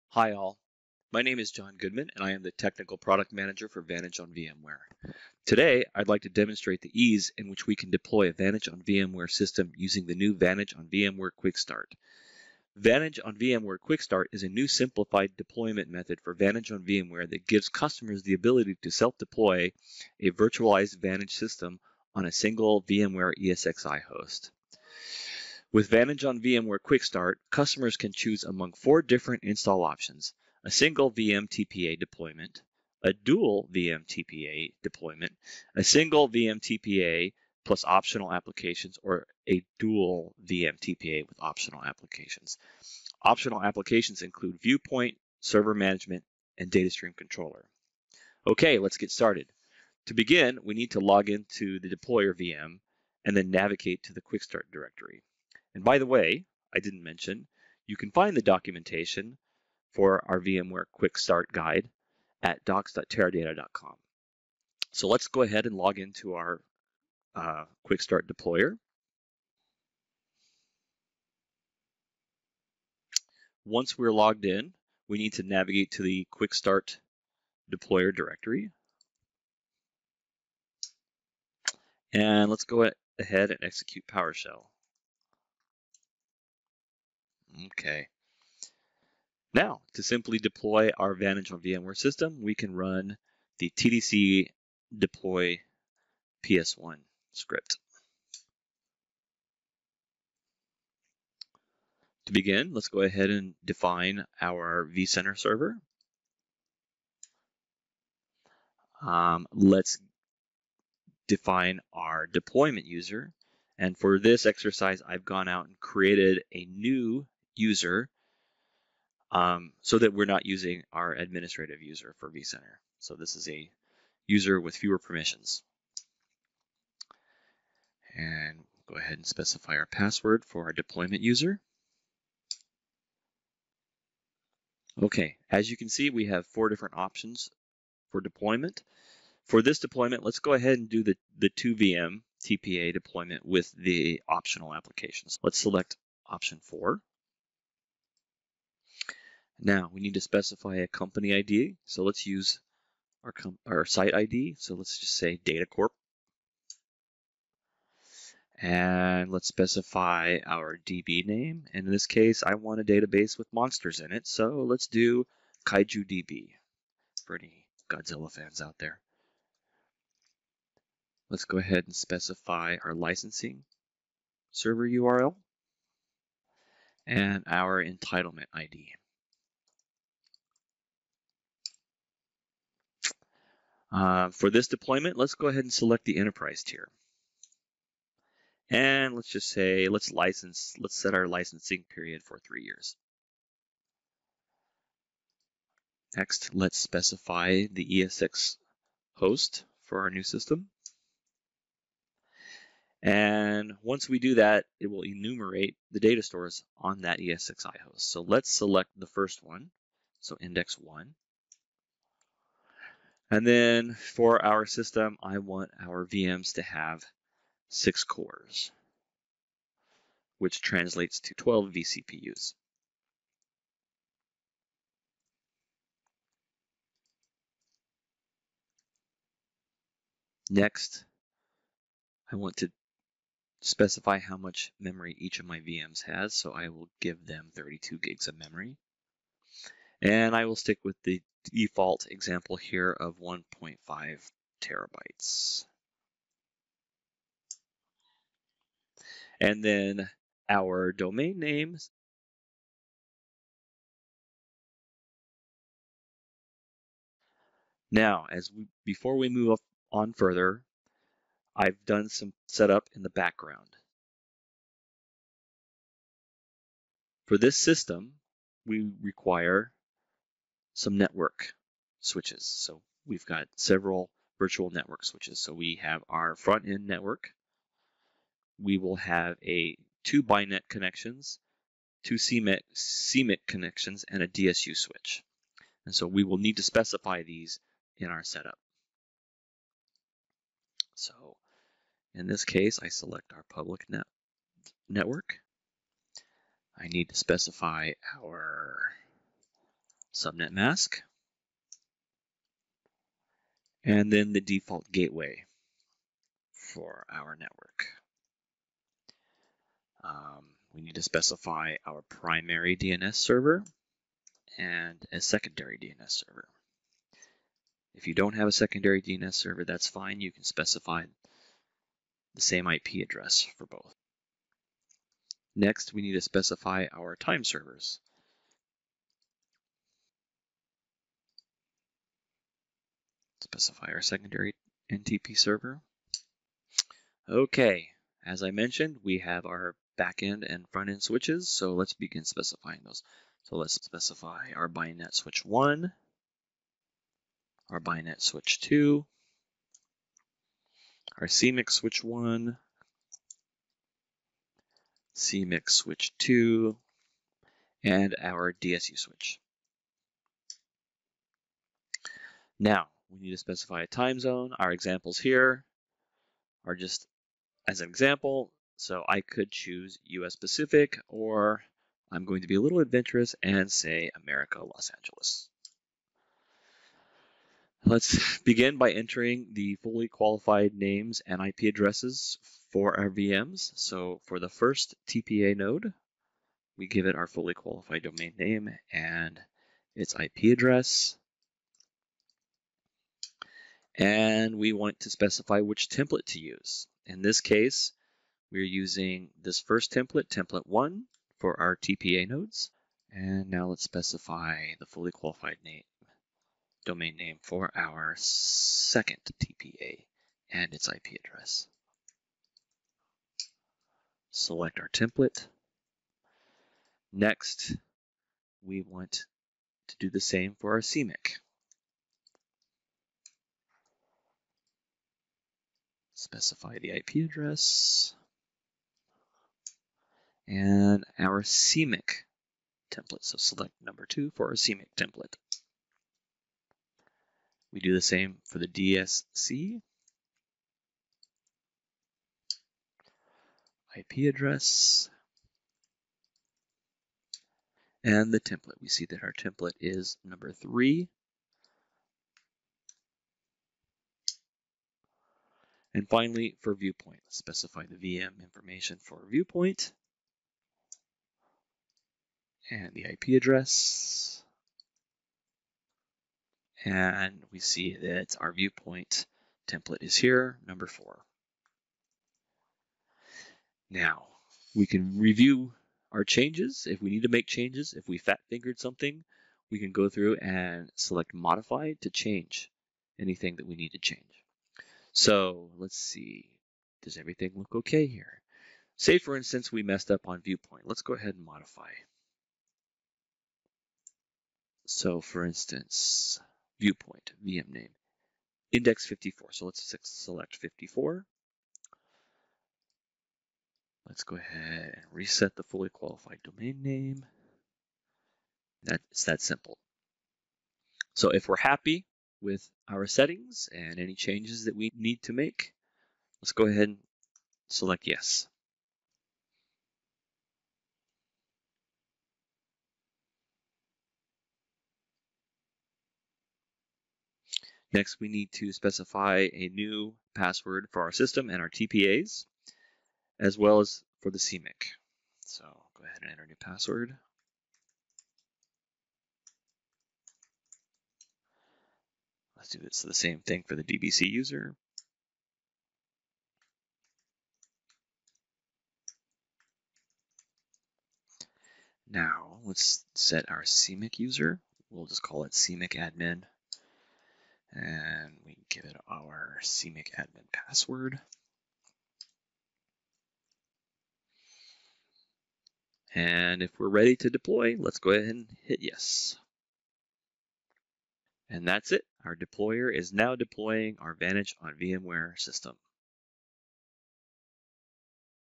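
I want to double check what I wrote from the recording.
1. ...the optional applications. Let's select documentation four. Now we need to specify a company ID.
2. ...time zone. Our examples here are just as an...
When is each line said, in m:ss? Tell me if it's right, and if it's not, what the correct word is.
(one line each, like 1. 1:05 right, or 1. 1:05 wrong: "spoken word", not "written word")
1. 2:23 wrong: "option", not "documentation"
2. 6:03 right.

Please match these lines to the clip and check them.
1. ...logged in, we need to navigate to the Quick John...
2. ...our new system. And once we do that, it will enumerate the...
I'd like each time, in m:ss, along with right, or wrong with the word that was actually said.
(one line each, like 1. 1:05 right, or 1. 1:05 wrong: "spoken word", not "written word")
1. 1:14 wrong: "Start", not "John"
2. 3:20 right.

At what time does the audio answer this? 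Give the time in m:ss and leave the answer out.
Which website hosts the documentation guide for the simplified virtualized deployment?
1:02.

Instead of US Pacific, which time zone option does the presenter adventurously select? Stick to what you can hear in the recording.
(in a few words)
America, Los Angeles.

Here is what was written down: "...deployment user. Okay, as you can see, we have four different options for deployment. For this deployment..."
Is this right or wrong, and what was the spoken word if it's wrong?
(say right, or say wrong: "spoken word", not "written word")
right.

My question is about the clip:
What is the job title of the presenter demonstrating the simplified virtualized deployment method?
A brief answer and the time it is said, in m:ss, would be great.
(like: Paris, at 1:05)
Technical Product Manager, at 0:02.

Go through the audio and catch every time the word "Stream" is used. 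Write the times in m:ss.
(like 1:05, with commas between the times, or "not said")
0:46.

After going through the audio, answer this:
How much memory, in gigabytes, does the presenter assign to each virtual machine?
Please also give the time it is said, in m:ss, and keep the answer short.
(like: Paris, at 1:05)
32, at 3:57.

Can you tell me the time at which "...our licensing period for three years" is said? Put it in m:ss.
3:11.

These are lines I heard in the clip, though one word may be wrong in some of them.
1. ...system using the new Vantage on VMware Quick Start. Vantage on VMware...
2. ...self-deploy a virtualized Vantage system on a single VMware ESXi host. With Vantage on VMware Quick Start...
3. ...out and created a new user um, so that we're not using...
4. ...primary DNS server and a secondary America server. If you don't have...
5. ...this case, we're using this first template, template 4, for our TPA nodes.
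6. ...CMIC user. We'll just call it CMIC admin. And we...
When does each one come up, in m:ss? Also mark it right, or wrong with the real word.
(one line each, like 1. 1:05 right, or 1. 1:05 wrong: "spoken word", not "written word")
1. 0:09 right
2. 0:18 right
3. 1:55 right
4. 5:12 wrong: "DNS", not "America"
5. 6:37 wrong: "1", not "4"
6. 9:13 right.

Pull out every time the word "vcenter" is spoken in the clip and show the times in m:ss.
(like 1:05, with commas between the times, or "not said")
1:44, 2:02.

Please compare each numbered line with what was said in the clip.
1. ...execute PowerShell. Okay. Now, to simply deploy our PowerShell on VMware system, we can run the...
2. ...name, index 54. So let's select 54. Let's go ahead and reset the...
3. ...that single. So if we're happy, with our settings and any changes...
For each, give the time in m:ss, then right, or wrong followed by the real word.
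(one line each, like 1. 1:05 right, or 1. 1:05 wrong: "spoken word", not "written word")
1. 1:23 wrong: "Vantage", not "PowerShell"
2. 8:17 right
3. 8:29 wrong: "simple", not "single".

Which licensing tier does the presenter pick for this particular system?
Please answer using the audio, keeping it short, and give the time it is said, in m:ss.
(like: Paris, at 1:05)
enterprise tier, at 3:06.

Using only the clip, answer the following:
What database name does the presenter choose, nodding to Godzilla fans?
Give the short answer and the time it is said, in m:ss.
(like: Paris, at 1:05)
Kaiju DB, at 2:45.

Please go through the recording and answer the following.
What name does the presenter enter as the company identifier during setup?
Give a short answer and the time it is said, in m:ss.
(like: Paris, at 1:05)
Data Corp, at 2:35.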